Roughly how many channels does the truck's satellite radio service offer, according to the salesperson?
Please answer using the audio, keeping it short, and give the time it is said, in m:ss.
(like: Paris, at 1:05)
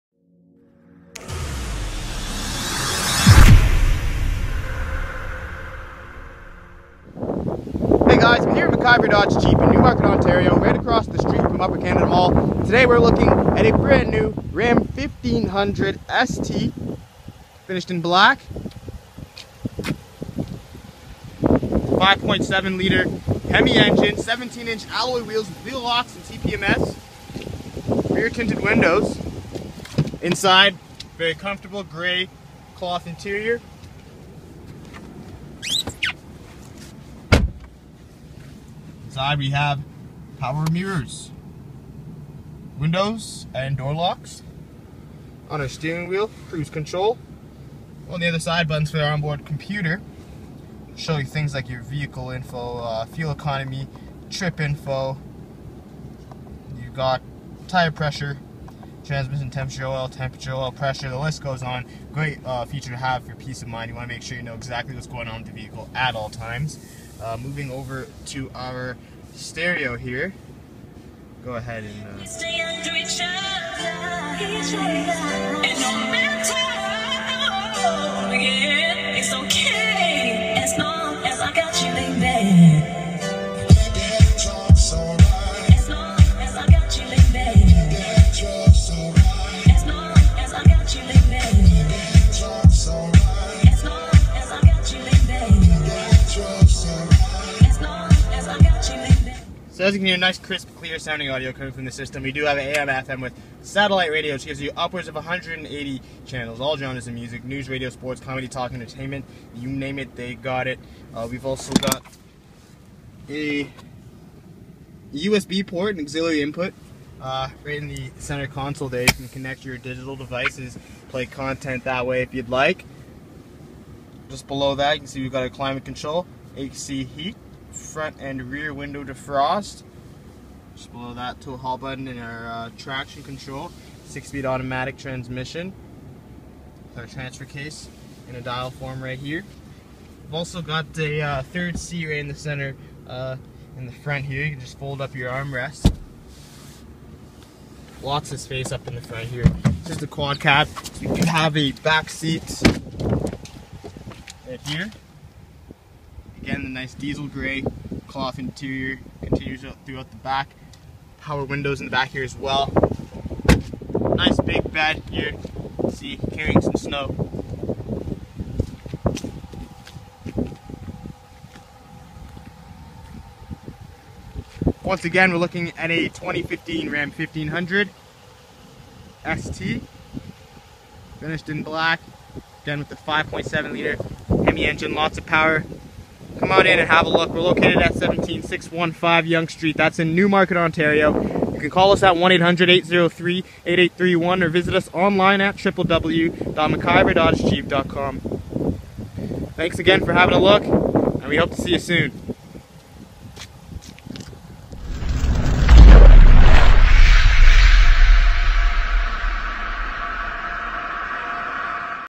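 180, at 1:45.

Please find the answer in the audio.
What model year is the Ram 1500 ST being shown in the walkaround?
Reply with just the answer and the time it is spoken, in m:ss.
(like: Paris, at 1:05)
2015, at 2:56.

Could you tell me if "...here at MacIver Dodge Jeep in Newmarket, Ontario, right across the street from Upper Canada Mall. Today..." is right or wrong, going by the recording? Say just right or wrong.
right.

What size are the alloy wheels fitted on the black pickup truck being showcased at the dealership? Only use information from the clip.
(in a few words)
17 inch.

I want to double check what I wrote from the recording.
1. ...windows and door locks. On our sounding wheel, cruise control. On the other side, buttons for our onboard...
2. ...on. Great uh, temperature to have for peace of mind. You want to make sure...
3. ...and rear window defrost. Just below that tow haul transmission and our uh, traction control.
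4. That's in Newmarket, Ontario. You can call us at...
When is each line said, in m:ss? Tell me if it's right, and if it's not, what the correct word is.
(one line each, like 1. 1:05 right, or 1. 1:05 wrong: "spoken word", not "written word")
1. 0:42 wrong: "steering", not "sounding"
2. 1:01 wrong: "feature", not "temperature"
3. 2:08 wrong: "button", not "transmission"
4. 3:09 right.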